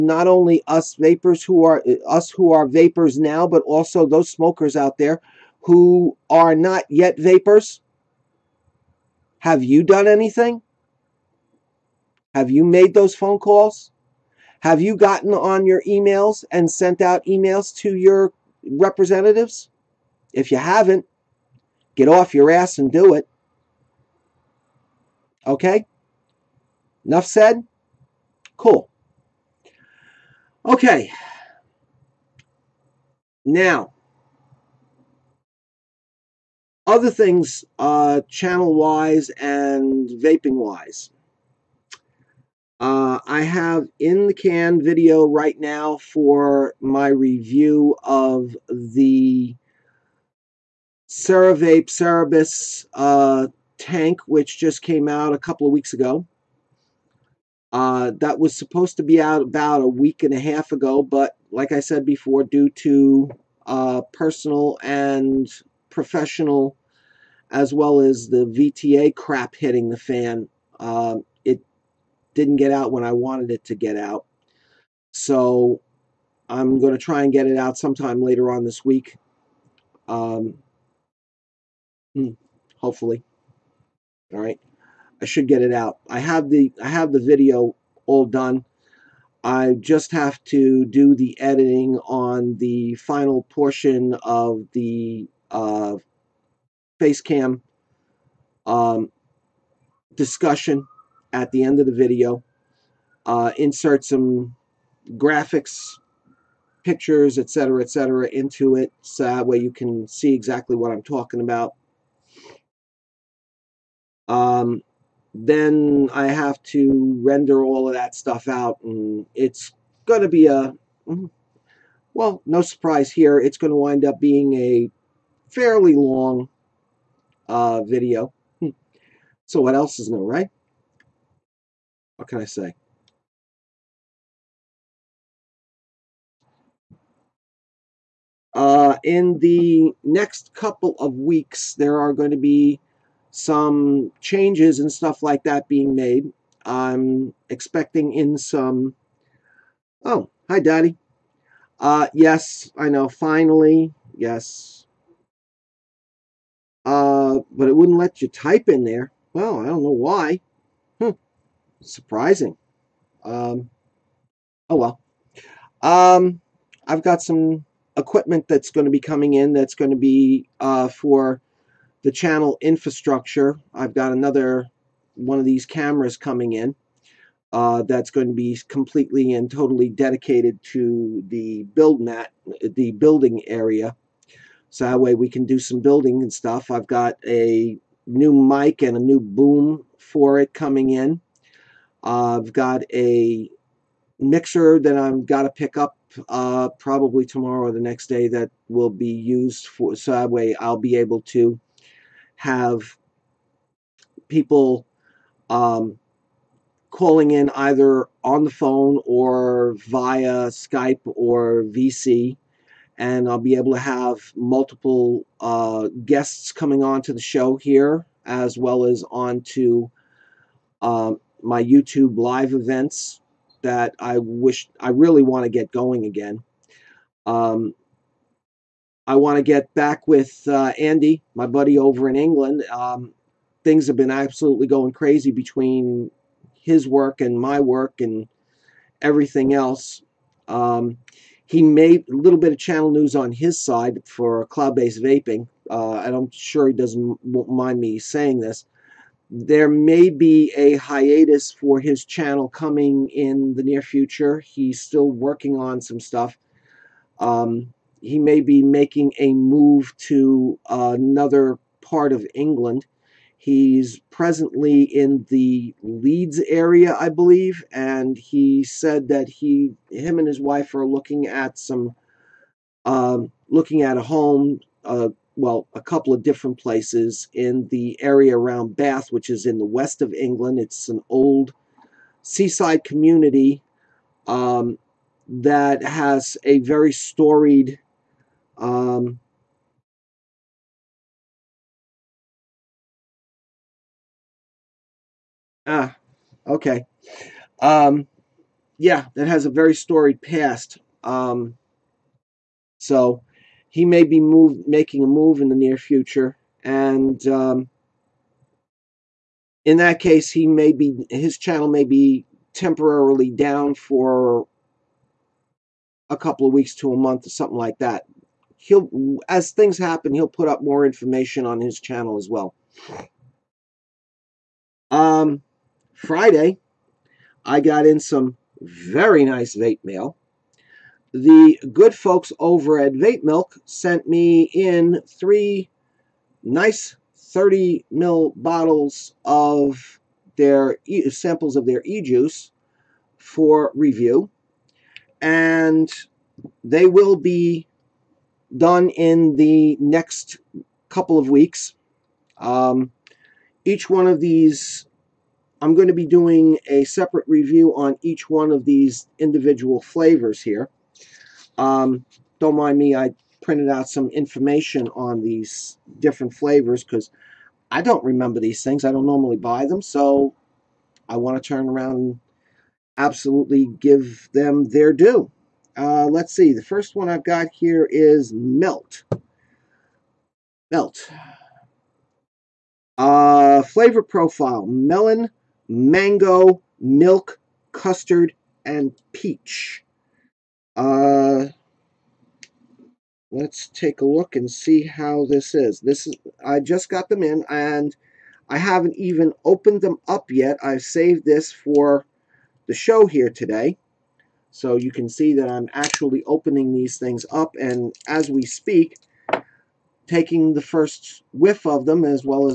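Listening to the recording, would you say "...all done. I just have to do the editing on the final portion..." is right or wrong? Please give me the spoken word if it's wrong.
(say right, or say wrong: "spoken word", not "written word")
right.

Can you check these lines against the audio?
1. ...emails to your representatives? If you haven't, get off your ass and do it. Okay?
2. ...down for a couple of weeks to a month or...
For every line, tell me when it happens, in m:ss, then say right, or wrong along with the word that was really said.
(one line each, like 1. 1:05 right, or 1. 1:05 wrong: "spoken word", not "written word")
1. 0:17 right
2. 5:13 right.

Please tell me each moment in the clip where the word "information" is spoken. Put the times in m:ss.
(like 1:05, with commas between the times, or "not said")
5:20, 6:04.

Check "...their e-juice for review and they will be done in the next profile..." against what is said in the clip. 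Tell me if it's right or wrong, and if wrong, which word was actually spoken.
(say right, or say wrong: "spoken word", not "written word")
wrong: "couple", not "profile".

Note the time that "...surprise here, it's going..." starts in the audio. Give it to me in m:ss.
2:02.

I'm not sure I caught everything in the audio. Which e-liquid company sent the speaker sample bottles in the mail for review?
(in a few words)
Vape Milk.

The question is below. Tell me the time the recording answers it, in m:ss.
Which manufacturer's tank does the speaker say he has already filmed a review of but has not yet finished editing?
0:51.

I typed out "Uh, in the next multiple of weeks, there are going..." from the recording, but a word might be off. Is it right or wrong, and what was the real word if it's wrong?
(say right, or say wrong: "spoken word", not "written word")
wrong: "couple", not "multiple".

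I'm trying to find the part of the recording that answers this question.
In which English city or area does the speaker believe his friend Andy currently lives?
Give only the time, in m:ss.
4:25.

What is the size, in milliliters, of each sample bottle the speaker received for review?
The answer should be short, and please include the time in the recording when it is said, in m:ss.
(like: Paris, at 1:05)
30, at 5:37.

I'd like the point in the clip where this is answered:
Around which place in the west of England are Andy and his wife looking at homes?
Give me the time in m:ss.
4:38.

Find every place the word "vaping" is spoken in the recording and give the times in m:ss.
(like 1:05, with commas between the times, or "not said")
0:40, 4:05.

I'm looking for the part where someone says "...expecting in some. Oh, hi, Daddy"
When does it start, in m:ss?
2:27.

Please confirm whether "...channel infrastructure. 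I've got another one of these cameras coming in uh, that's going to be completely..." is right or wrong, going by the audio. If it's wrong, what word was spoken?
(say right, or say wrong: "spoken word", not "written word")
right.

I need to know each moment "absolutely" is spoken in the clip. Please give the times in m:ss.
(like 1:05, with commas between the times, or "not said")
3:54, 6:12.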